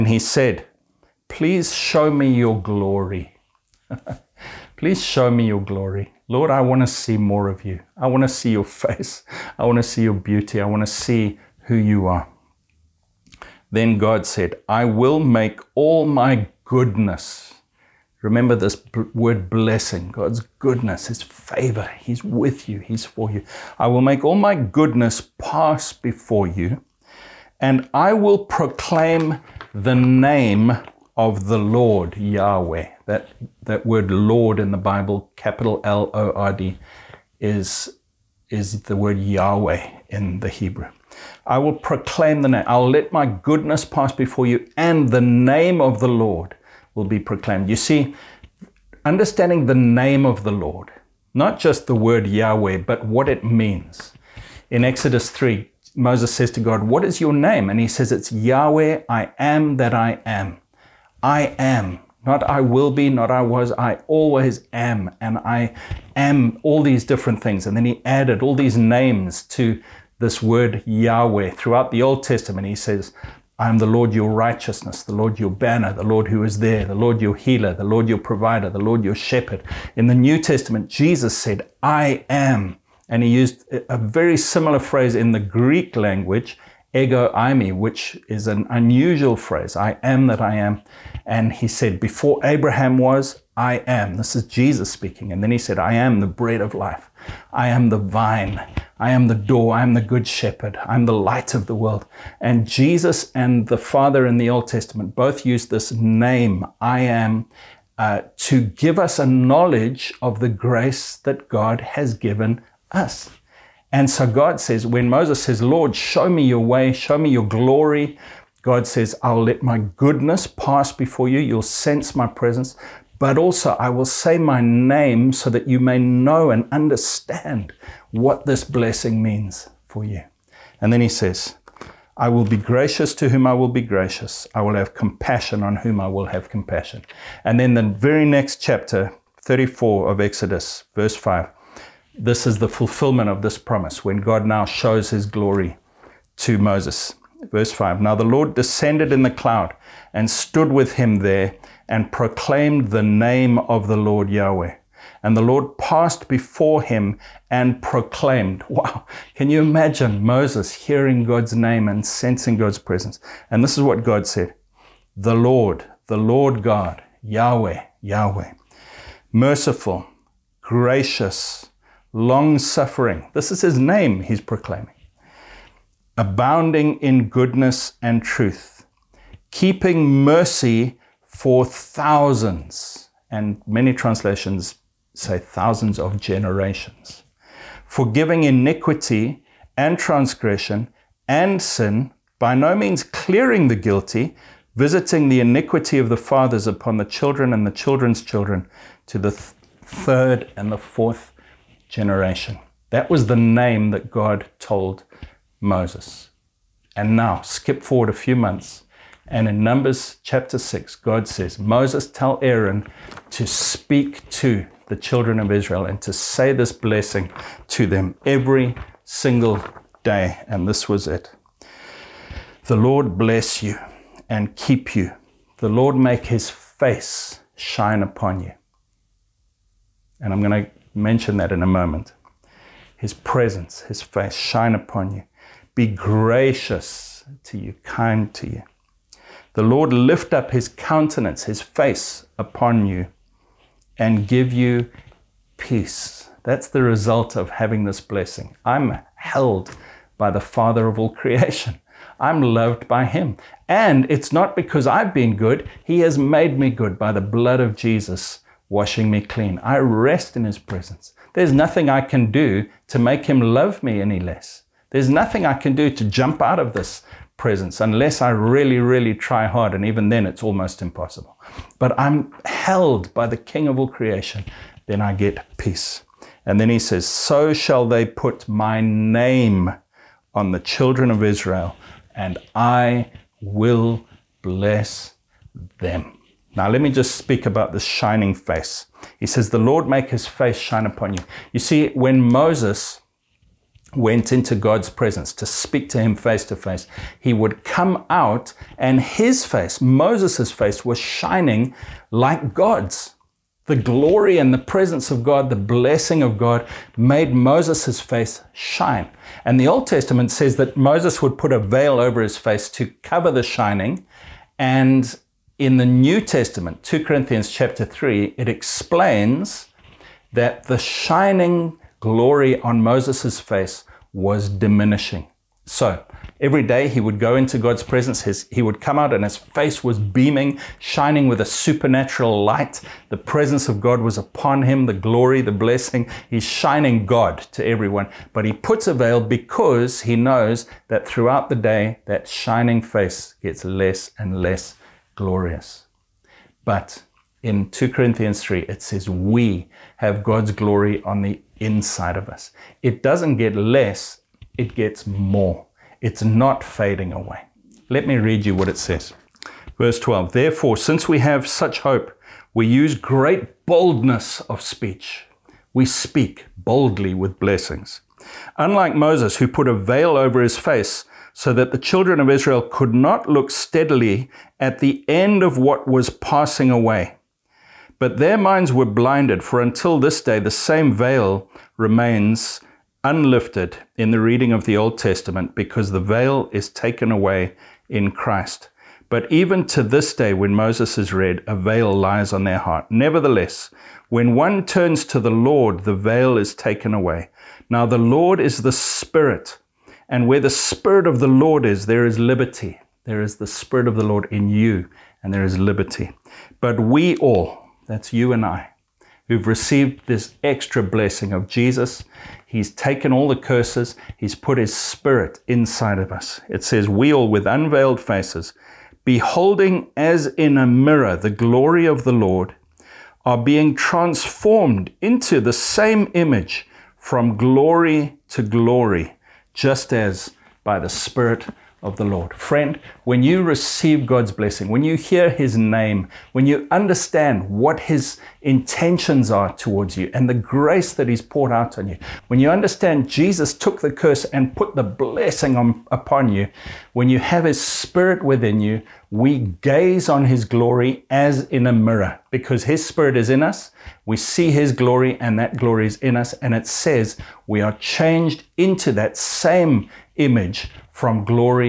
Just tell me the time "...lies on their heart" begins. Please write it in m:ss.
6:31.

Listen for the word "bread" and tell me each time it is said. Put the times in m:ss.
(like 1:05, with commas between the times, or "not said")
1:36.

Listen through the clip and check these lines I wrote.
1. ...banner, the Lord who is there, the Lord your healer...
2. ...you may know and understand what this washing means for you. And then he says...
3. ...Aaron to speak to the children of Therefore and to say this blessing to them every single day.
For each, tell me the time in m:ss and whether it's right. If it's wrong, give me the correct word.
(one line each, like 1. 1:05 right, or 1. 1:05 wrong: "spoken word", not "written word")
1. 1:15 right
2. 2:05 wrong: "blessing", not "washing"
3. 3:32 wrong: "Israel", not "Therefore".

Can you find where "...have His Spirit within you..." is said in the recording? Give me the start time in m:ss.
7:27.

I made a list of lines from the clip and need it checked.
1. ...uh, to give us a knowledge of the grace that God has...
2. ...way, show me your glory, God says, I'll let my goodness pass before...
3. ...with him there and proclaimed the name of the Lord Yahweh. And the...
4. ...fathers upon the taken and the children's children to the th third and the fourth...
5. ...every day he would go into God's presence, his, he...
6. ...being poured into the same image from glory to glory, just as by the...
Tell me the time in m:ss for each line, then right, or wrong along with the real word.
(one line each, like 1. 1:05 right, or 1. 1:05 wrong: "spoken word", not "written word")
1. 1:47 right
2. 1:56 right
3. 2:30 right
4. 3:16 wrong: "children", not "taken"
5. 5:26 right
6. 7:03 wrong: "transformed", not "poured".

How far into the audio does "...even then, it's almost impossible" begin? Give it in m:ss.
4:29.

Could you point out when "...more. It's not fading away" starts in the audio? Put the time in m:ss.
5:55.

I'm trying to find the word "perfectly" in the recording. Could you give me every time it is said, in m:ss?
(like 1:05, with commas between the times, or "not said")
not said.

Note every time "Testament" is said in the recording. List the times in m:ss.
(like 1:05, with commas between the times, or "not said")
1:12, 1:20, 1:44, 5:09, 5:16, 6:24.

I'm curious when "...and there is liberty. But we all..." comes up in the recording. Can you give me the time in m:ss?
6:45.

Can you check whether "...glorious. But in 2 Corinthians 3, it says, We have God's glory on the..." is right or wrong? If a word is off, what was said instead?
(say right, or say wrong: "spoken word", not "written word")
right.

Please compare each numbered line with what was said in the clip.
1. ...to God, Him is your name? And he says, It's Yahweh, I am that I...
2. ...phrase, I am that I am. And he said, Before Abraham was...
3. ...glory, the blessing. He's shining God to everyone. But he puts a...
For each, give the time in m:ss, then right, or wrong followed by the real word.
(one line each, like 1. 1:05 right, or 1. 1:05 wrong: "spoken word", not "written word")
1. 0:56 wrong: "What", not "Him"
2. 1:29 right
3. 5:34 right.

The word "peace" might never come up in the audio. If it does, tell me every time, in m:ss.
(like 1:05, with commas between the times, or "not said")
4:05, 4:35.